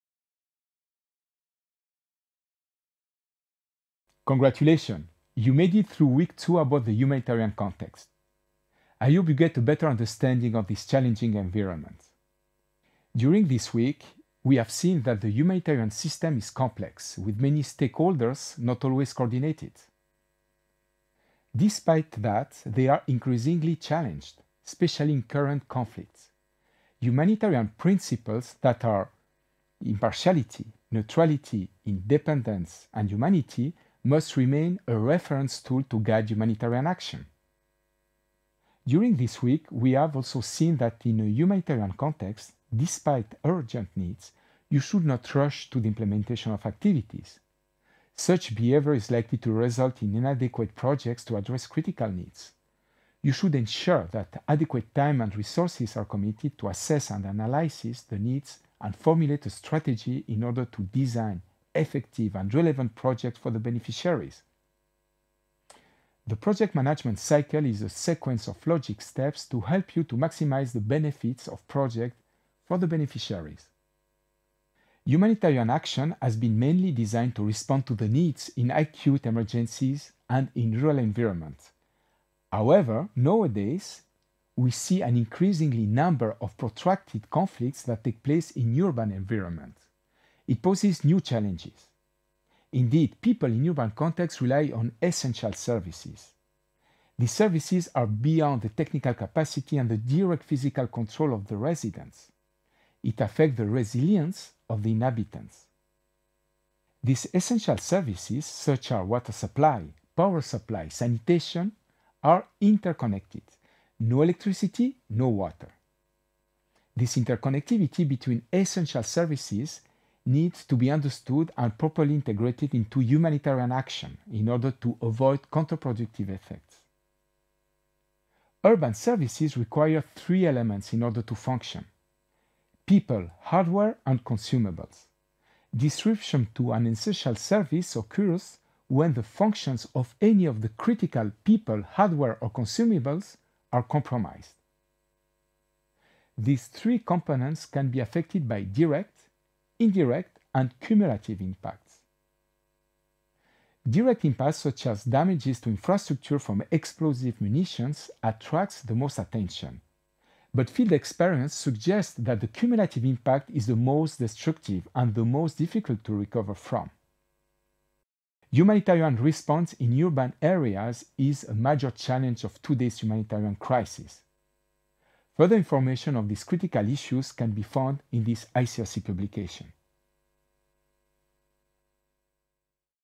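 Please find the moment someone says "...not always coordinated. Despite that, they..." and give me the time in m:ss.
0:18.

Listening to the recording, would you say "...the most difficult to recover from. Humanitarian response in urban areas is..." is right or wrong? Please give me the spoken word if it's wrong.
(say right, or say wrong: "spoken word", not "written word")
right.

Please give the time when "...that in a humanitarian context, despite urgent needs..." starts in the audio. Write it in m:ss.
0:40.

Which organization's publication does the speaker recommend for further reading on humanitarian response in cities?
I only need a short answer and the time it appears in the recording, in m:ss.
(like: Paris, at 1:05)
ICRC, at 2:58.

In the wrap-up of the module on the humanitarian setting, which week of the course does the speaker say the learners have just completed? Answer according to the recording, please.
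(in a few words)
week two.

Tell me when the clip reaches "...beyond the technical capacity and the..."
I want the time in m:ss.
1:38.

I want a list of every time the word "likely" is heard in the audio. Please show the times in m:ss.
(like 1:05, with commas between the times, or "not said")
0:49.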